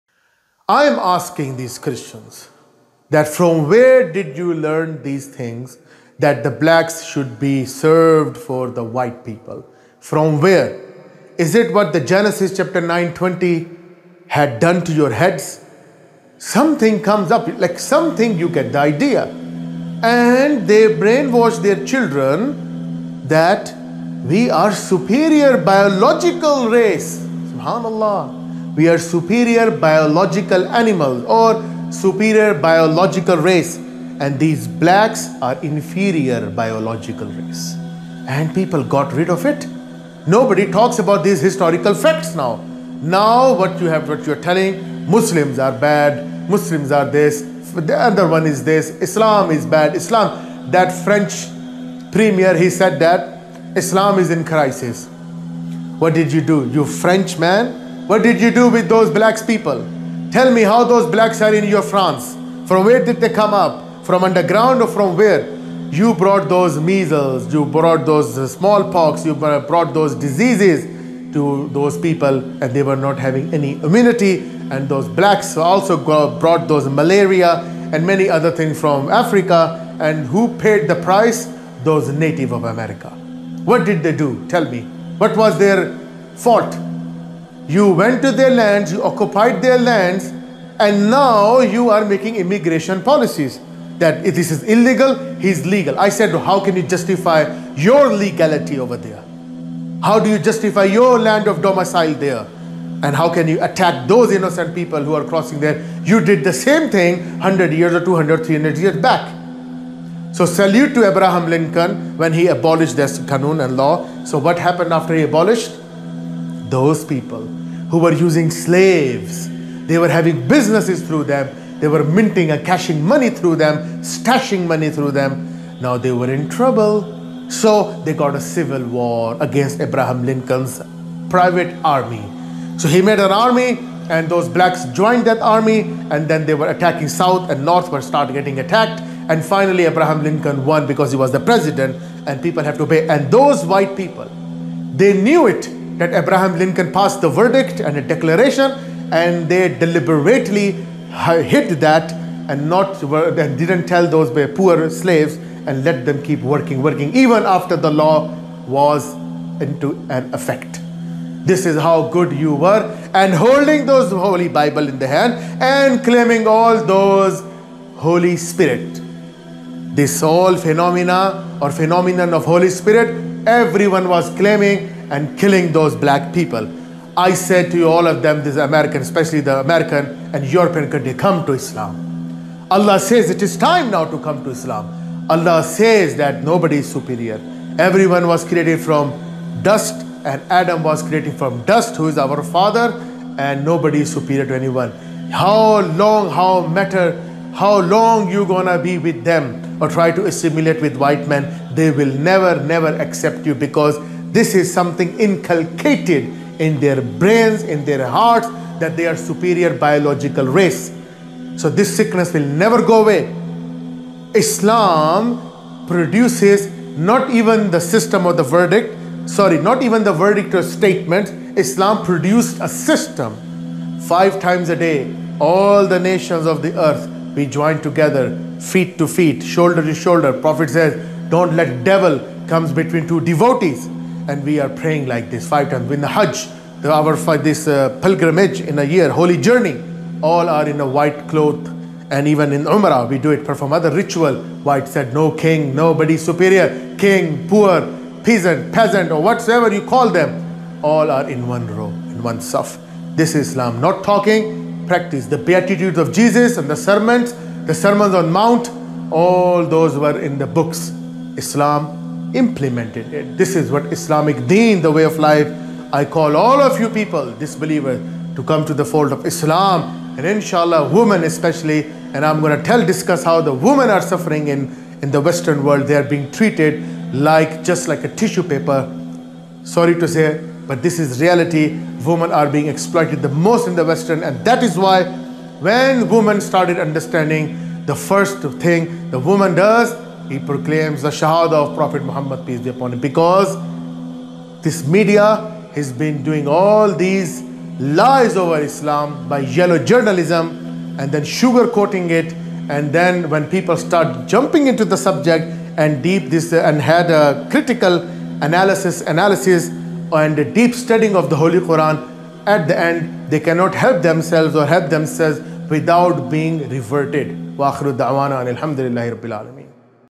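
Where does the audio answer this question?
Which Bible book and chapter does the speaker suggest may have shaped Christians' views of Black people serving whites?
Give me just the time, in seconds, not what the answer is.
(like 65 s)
11 s.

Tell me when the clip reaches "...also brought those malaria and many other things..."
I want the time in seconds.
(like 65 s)
75 s.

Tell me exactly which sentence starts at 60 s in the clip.
Tell me how those blacks are in your France.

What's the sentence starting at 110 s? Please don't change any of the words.
So salute to Abraham Lincoln when he abolished this Kanun and law.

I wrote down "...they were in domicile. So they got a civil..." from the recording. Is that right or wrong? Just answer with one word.
wrong.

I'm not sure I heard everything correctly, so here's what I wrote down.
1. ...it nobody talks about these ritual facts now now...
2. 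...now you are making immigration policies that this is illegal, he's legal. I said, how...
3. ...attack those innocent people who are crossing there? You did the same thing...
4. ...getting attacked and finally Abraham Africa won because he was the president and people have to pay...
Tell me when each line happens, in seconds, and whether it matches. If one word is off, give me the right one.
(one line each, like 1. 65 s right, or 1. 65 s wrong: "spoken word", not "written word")
1. 39 s wrong: "historical", not "ritual"
2. 91 s right
3. 103 s right
4. 138 s wrong: "Lincoln", not "Africa".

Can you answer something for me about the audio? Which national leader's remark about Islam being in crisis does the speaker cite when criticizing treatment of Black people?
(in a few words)
French premier.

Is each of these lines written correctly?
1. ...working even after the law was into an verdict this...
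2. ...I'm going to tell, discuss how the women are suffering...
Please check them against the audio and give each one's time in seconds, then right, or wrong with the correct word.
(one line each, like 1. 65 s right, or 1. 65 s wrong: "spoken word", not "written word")
1. 156 s wrong: "effect", not "verdict"
2. 272 s right.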